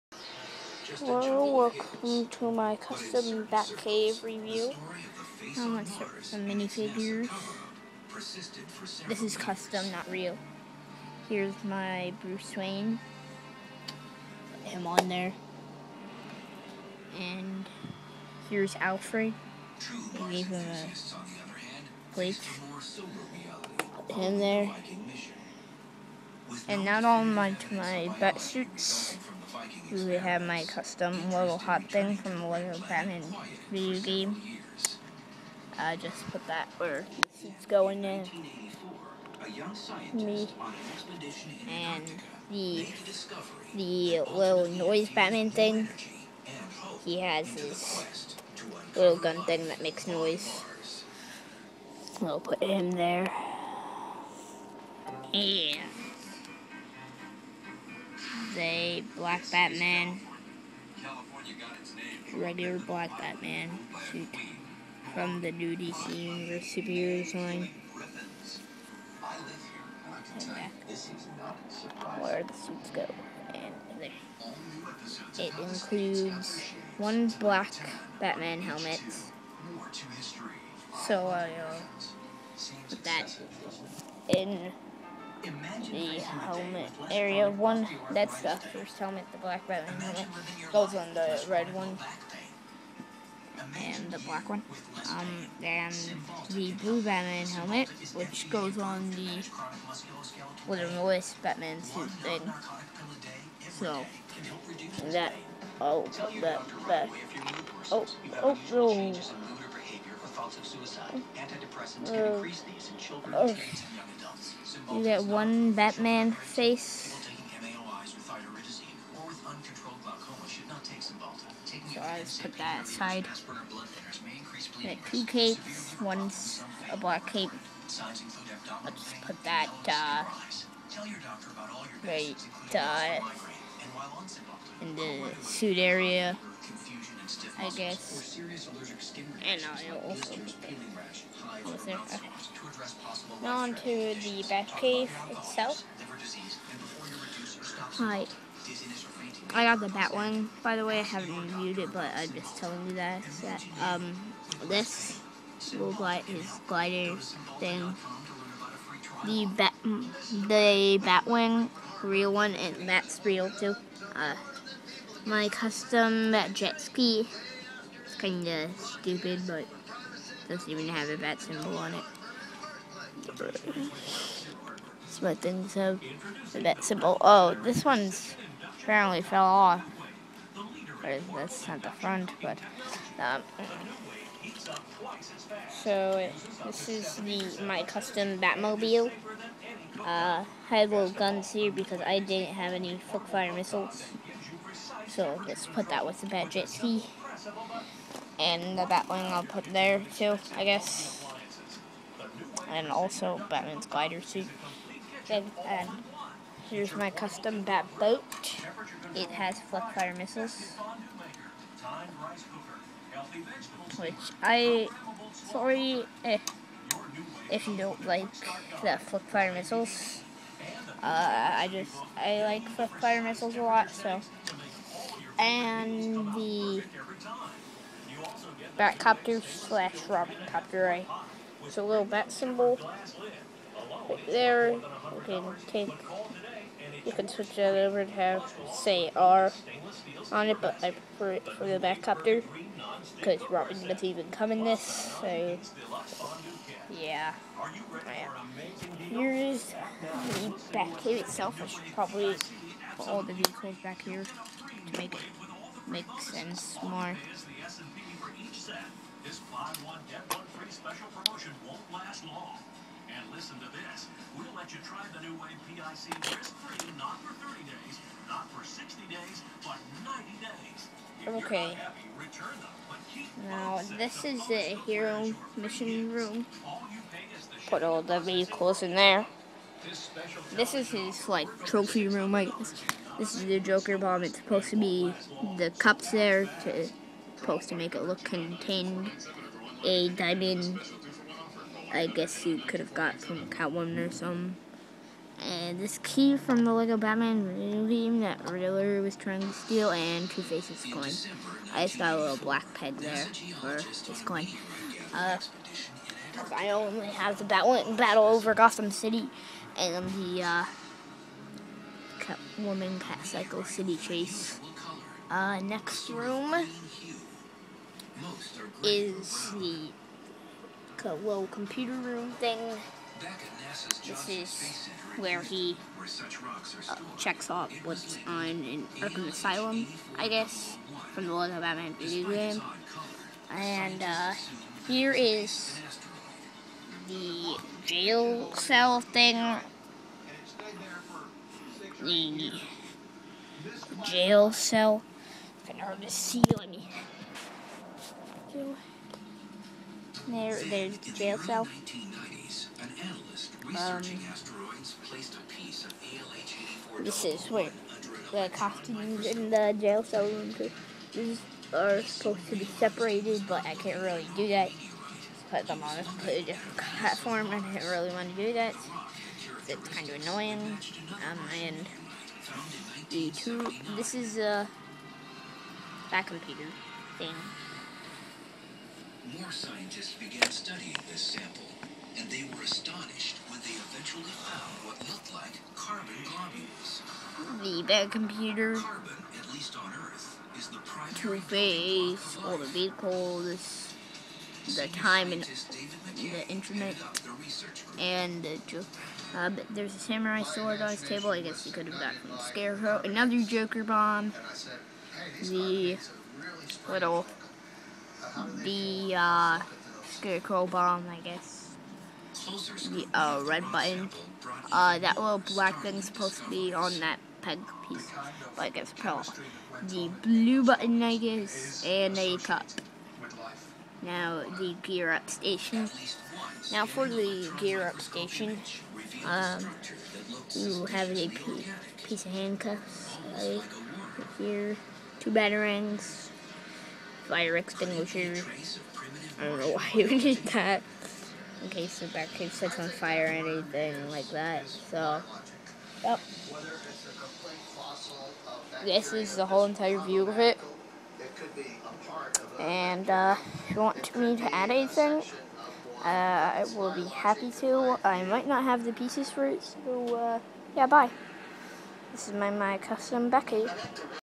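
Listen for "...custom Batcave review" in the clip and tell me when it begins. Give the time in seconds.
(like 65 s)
2 s.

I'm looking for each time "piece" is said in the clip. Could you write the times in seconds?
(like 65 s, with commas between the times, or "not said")
417 s, 432 s, 458 s.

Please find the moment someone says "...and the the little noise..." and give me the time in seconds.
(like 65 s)
41 s.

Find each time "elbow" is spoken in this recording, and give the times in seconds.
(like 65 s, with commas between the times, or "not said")
not said.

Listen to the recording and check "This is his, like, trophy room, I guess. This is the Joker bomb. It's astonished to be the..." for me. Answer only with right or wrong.
wrong.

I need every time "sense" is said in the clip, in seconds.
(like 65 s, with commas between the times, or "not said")
256 s.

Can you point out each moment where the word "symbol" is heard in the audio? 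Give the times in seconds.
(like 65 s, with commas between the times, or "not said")
171 s, 176 s, 232 s.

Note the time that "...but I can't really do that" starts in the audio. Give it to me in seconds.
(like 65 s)
363 s.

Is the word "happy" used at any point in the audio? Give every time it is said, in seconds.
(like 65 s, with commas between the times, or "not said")
271 s, 457 s.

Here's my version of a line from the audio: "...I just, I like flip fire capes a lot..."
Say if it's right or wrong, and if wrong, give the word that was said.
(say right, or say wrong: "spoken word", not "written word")
wrong: "missiles", not "capes".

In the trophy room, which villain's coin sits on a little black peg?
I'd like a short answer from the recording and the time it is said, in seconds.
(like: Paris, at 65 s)
Two Face, at 300 s.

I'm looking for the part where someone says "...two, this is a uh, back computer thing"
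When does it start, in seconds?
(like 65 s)
373 s.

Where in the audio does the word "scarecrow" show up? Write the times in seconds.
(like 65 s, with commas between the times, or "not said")
402 s, 410 s.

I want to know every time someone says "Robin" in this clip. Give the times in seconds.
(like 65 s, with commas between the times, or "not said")
243 s.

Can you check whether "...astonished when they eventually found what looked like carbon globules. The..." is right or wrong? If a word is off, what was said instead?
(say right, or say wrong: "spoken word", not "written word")
right.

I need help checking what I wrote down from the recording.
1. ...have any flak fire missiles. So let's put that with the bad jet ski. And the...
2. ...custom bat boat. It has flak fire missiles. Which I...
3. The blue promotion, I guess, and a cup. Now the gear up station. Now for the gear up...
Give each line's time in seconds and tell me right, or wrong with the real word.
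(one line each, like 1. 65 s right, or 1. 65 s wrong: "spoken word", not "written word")
1. 192 s right
2. 207 s right
3. 419 s wrong: "button", not "promotion".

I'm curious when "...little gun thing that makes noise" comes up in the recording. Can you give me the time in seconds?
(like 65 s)
48 s.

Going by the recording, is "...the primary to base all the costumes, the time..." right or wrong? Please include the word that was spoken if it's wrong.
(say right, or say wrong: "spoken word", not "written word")
wrong: "vehicles", not "costumes".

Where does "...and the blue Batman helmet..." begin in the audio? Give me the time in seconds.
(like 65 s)
95 s.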